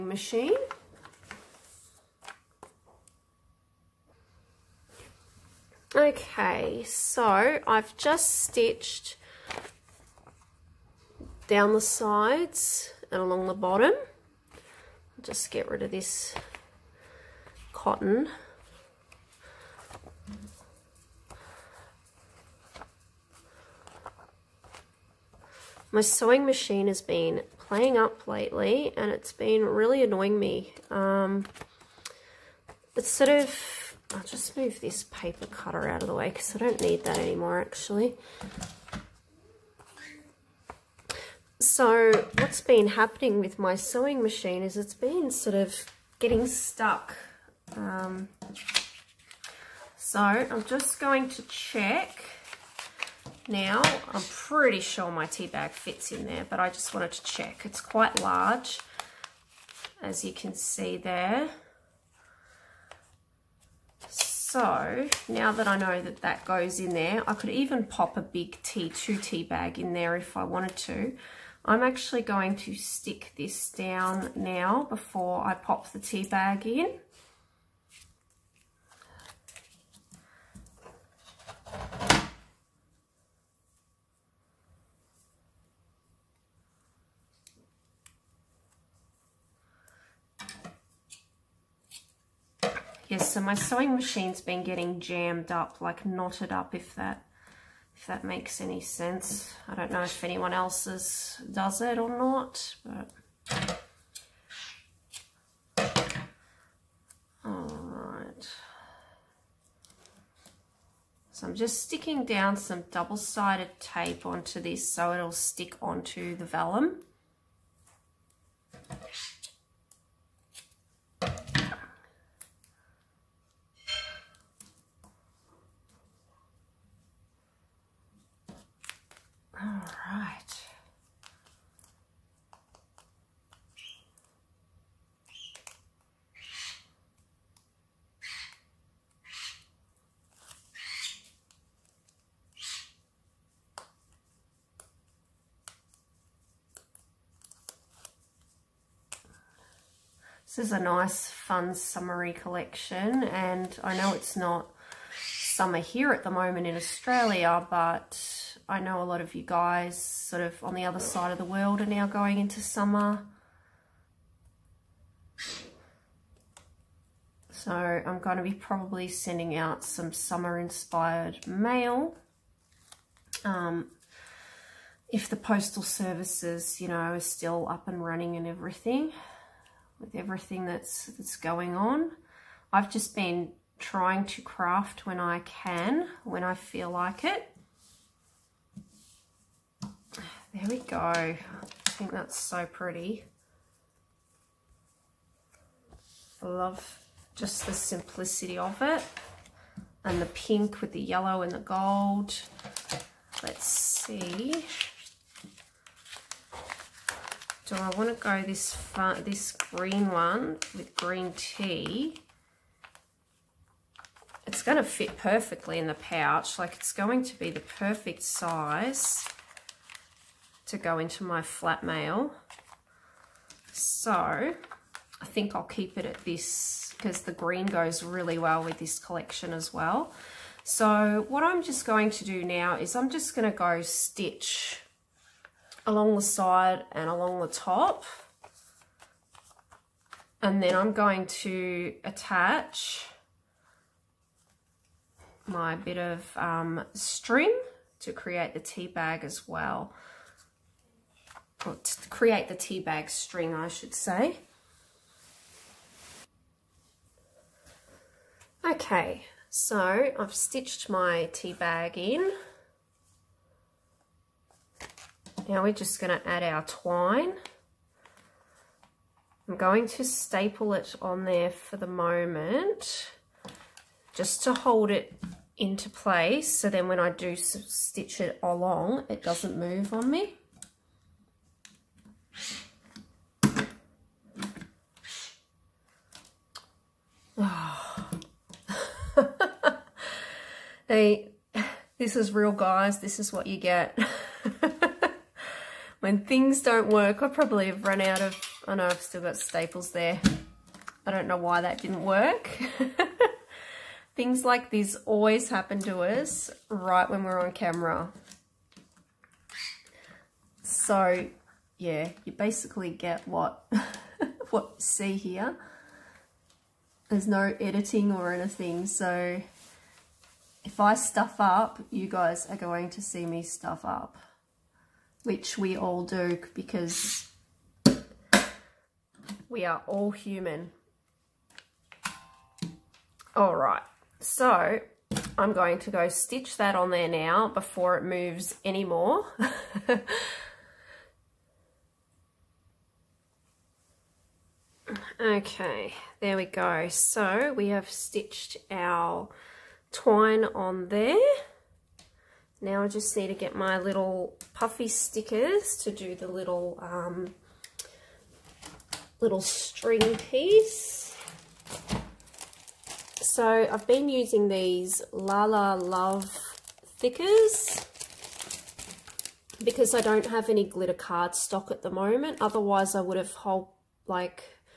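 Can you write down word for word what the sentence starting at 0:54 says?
I'm pretty sure my tea bag fits in there, but I just wanted to check.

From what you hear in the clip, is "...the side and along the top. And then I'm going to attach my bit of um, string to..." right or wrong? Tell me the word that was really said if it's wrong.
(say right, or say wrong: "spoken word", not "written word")
right.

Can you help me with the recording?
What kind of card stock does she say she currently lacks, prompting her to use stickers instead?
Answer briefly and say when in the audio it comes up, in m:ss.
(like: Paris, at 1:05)
glitter card stock, at 6:10.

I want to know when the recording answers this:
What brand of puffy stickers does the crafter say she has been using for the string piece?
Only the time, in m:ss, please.
6:05.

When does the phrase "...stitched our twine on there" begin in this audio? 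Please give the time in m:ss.
5:47.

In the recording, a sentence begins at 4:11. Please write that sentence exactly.
Or to create the tea bag string, I should say.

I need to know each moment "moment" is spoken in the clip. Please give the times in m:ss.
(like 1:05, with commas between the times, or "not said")
2:36, 4:31, 6:11.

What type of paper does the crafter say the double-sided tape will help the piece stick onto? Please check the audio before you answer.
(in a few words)
vellum.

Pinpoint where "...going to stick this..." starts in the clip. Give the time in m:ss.
1:12.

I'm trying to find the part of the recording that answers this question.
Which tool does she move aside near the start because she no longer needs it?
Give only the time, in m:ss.
0:35.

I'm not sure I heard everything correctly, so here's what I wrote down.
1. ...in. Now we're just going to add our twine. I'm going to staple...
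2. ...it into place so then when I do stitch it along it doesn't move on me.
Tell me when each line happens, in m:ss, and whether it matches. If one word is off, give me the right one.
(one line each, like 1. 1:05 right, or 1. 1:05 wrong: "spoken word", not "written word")
1. 4:21 right
2. 4:34 right.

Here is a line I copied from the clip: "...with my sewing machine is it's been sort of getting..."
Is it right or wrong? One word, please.
right.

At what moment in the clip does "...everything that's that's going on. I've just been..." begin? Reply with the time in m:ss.
3:00.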